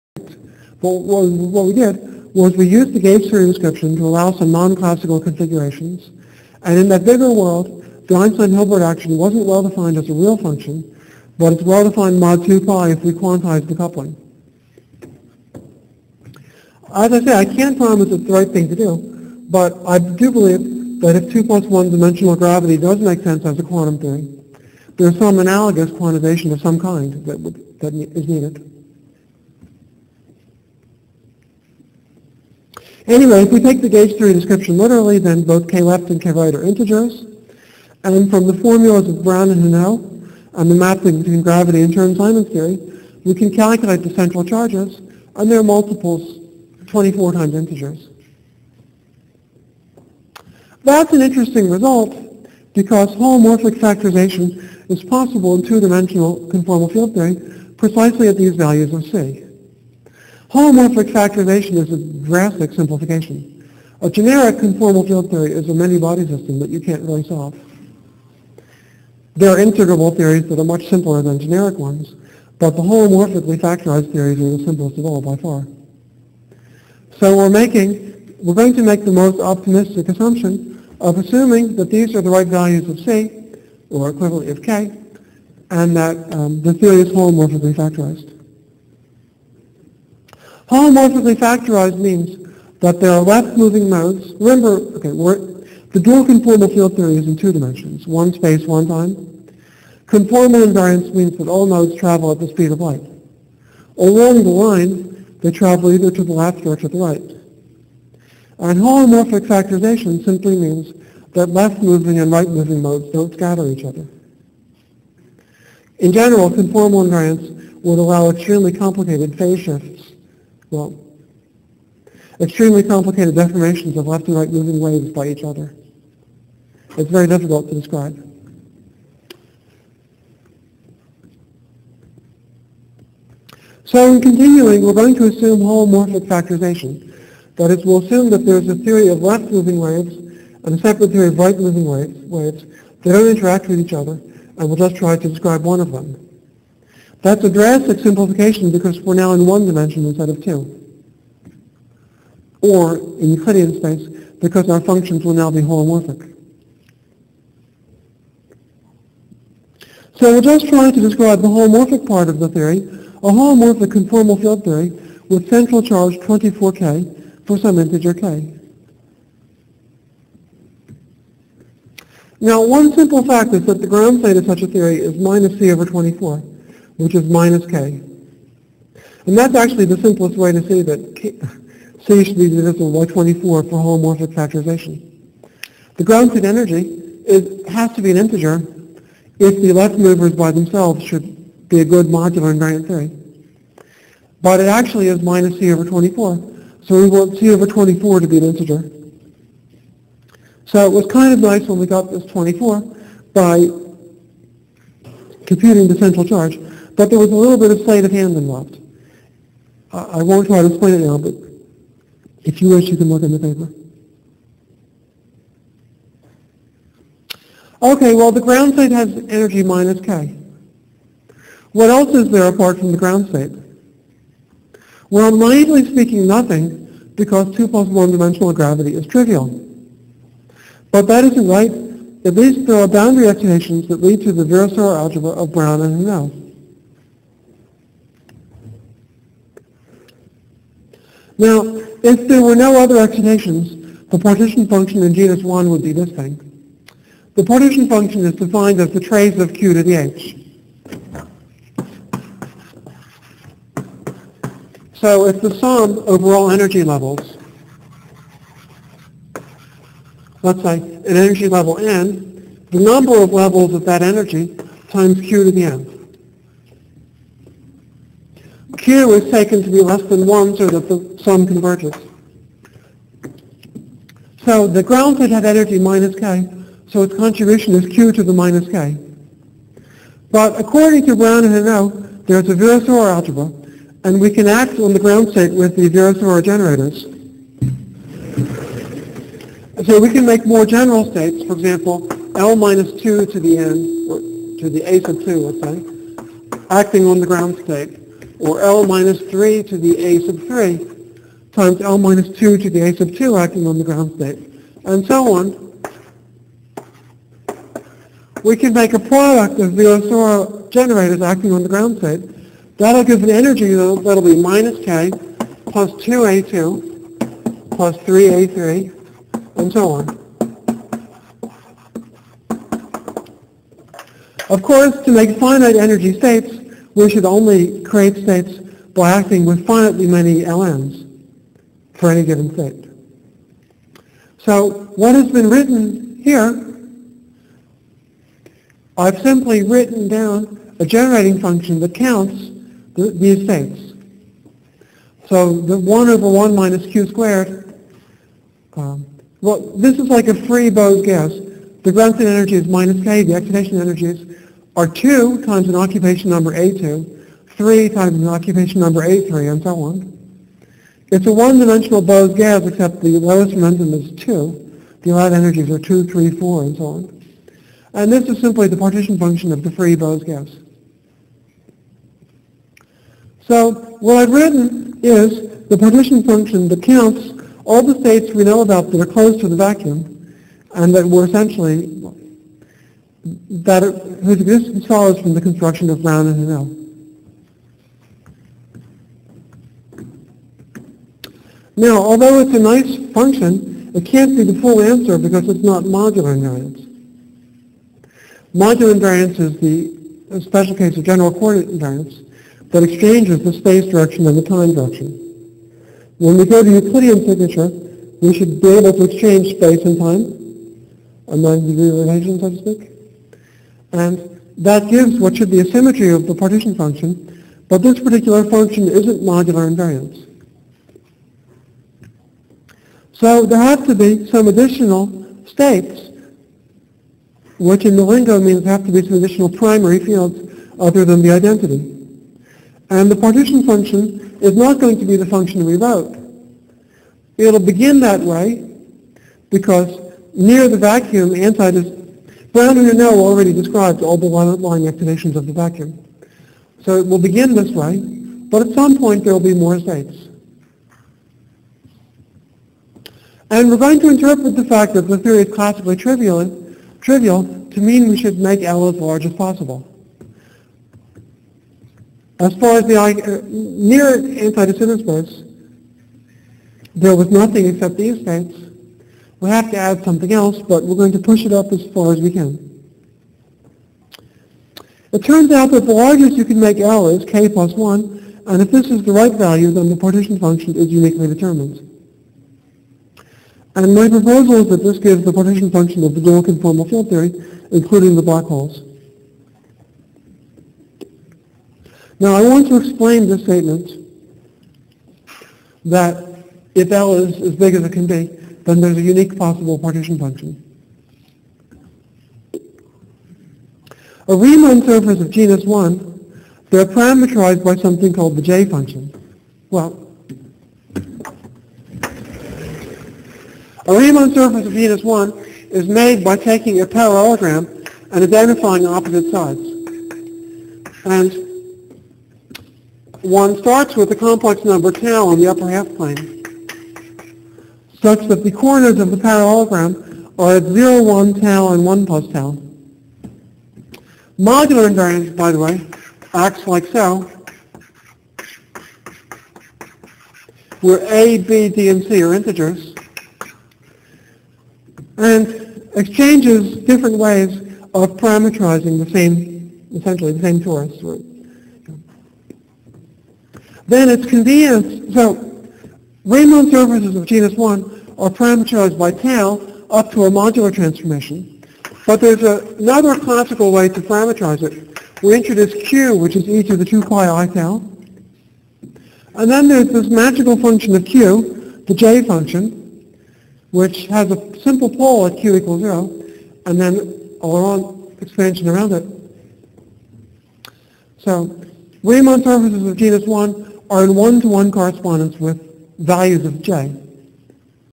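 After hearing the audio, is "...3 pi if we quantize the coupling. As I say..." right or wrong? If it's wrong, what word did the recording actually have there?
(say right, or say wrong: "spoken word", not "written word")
wrong: "2", not "3".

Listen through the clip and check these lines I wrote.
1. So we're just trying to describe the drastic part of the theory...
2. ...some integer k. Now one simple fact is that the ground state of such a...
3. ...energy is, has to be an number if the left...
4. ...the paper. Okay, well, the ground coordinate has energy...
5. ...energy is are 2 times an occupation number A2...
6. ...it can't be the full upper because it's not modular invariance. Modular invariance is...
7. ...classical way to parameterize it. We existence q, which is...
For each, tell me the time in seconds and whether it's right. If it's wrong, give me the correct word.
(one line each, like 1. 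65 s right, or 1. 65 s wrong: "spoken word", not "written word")
1. 160 s wrong: "holomorphic", not "drastic"
2. 167 s right
3. 186 s wrong: "integer", not "number"
4. 213 s wrong: "state", not "coordinate"
5. 353 s right
6. 393 s wrong: "answer", not "upper"
7. 563 s wrong: "introduce", not "existence".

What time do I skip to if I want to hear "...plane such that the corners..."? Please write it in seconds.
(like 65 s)
525 s.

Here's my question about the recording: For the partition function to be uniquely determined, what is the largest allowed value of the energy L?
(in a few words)
k plus 1.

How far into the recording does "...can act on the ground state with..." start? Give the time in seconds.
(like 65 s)
284 s.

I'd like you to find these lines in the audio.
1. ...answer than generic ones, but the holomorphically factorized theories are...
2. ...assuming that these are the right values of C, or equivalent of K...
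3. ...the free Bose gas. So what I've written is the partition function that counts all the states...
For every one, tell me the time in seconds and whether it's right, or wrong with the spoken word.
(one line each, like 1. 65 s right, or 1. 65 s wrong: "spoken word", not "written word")
1. 70 s wrong: "simpler", not "answer"
2. 81 s right
3. 369 s right.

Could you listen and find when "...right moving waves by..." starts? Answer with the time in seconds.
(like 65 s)
124 s.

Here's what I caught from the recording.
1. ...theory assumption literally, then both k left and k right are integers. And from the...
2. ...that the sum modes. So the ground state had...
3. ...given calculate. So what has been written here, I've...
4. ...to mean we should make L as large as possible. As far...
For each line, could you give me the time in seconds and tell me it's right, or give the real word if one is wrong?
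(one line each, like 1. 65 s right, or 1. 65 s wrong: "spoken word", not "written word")
1. 34 s wrong: "description", not "assumption"
2. 270 s wrong: "converges", not "modes"
3. 332 s wrong: "state", not "calculate"
4. 457 s right.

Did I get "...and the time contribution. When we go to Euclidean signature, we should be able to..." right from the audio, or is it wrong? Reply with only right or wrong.
wrong.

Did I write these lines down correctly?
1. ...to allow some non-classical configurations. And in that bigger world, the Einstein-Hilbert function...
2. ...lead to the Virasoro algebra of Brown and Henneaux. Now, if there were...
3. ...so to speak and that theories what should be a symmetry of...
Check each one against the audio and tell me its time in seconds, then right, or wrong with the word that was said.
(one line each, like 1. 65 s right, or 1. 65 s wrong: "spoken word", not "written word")
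1. 3 s wrong: "action", not "function"
2. 234 s right
3. 412 s wrong: "gives", not "theories".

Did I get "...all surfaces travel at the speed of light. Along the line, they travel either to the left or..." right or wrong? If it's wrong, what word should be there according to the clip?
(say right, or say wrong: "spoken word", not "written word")
wrong: "modes", not "surfaces".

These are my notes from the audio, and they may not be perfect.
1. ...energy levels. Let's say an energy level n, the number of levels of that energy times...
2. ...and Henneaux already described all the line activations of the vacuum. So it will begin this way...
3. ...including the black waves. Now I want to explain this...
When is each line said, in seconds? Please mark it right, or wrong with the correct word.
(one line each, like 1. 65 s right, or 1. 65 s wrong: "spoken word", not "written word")
1. 256 s right
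2. 442 s right
3. 487 s wrong: "holes", not "waves".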